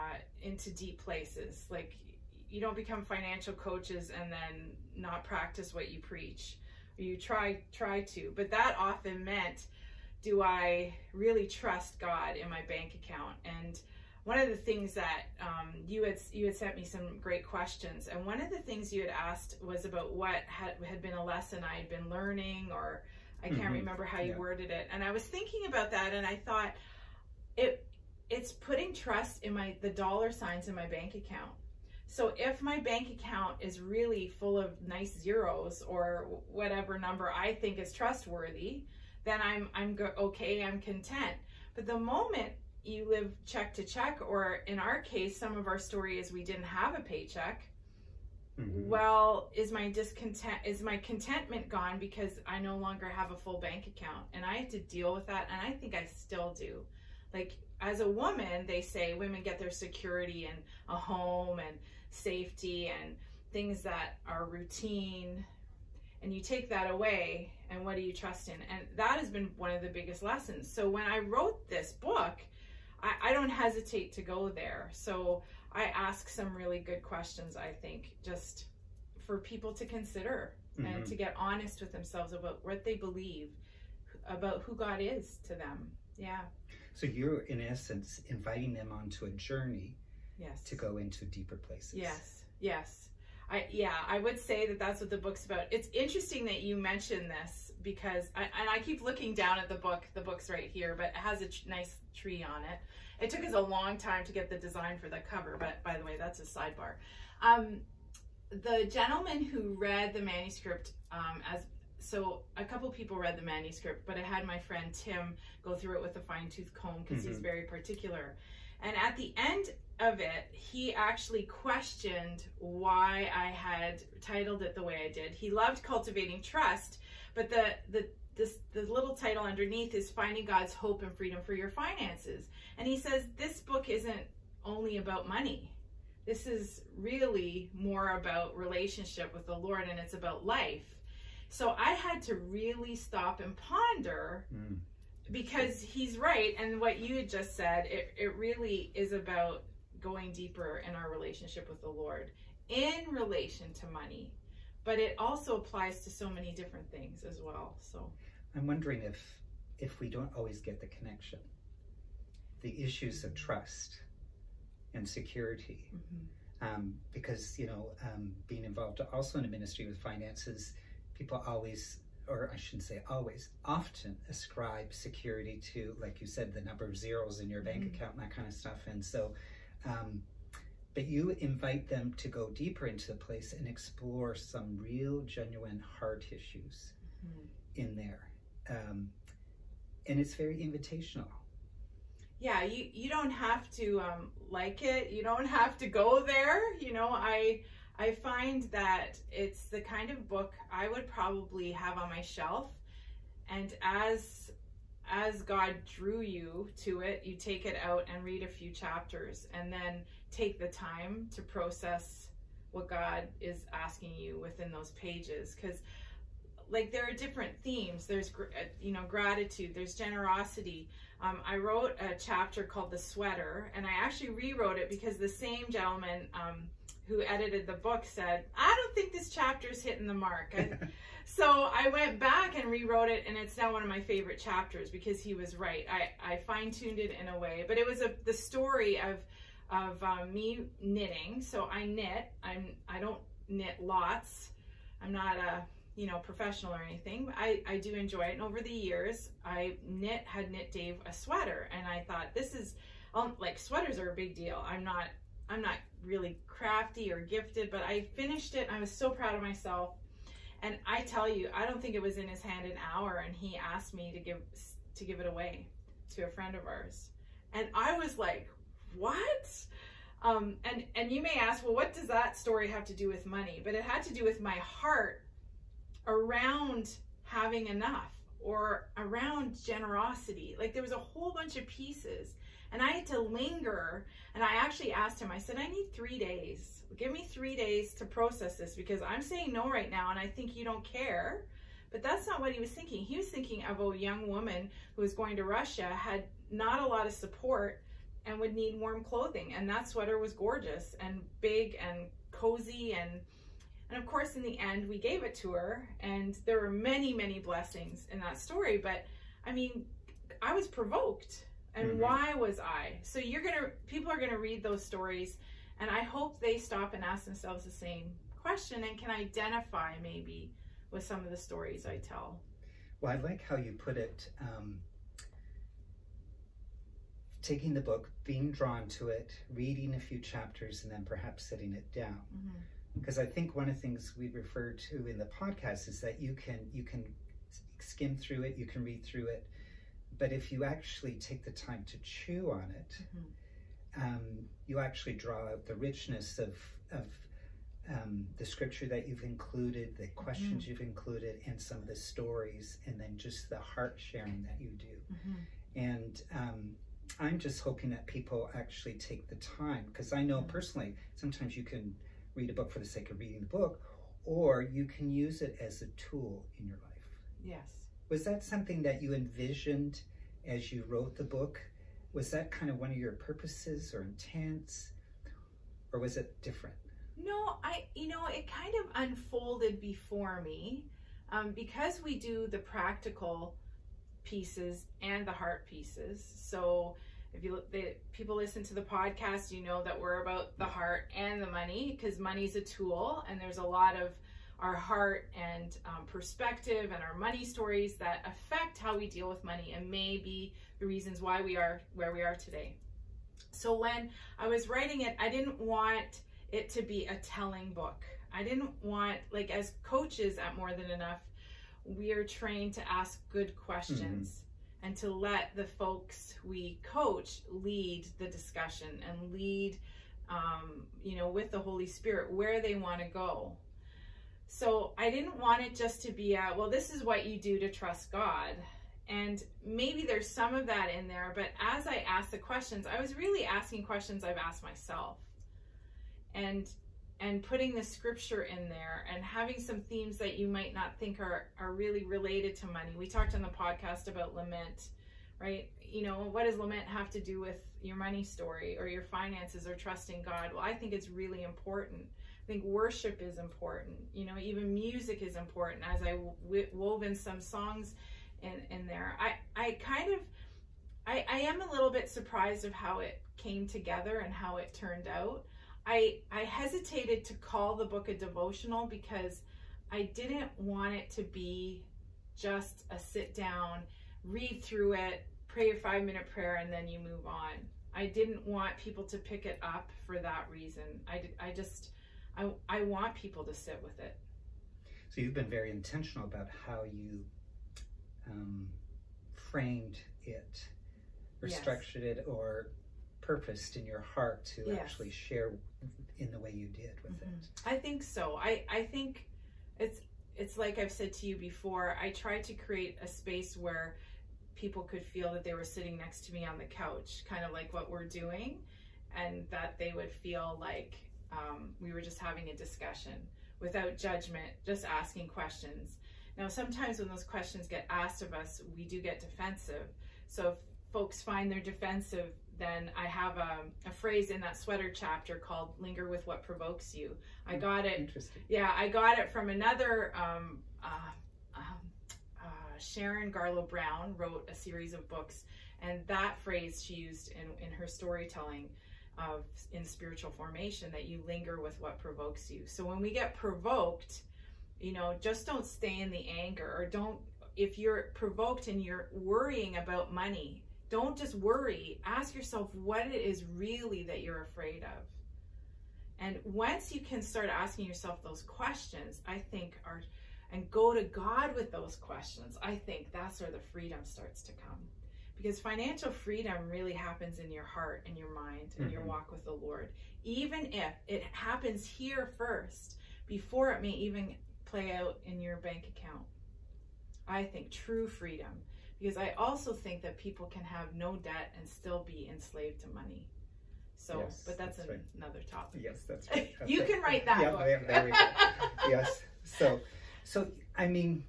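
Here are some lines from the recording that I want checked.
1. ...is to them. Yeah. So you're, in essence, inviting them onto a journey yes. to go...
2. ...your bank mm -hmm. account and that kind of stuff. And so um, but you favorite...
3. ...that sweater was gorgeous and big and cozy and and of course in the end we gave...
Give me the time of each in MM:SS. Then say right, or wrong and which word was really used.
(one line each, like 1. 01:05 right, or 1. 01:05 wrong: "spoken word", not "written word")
1. 01:24 right
2. 02:57 wrong: "invite", not "favorite"
3. 04:59 right.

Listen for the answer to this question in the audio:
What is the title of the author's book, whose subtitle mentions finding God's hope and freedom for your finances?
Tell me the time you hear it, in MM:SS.
02:05.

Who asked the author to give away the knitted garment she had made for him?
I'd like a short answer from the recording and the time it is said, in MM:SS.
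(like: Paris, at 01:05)
Dave, at 04:10.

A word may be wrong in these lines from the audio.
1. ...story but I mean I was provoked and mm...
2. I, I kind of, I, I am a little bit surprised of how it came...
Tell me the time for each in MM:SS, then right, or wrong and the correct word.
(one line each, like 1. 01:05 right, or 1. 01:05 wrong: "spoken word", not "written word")
1. 05:08 right
2. 07:39 right.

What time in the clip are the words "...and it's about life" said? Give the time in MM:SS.
02:19.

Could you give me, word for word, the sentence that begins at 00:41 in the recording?
But the moment you live check to check, or in our case, some of our story is we didn't have a paycheck.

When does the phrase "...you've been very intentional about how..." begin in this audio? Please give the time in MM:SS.
08:05.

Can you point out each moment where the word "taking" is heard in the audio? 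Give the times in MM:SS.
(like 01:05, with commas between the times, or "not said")
05:27.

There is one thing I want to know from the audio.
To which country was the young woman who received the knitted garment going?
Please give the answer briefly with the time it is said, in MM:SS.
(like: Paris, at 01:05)
Russia, at 04:55.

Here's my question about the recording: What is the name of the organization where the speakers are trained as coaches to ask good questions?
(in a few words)
More Than Enough.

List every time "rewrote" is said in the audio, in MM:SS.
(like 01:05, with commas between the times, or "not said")
03:44, 03:52.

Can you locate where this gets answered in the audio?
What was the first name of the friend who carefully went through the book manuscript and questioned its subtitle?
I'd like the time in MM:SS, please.
01:54.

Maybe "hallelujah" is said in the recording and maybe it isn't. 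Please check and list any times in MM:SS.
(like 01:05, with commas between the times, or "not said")
not said.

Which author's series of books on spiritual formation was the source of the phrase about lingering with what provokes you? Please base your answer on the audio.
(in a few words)
Sharon Garlough Brown.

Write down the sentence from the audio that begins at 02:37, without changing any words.
So I'm wondering if if we don't always get the connection, the issues of trust and security, mm -hmm.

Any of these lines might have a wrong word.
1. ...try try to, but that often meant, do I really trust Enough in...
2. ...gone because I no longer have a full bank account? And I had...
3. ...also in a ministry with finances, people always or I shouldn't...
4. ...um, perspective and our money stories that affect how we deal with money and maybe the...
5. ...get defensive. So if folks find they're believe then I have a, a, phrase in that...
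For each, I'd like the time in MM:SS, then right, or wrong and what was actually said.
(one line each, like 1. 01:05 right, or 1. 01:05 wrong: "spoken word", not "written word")
1. 00:07 wrong: "God", not "Enough"
2. 00:51 right
3. 02:49 right
4. 06:35 right
5. 08:39 wrong: "defensive", not "believe".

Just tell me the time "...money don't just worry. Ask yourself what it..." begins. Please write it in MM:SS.
09:10.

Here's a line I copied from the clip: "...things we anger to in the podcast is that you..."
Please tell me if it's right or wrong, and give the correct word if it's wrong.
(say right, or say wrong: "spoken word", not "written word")
wrong: "refer", not "anger".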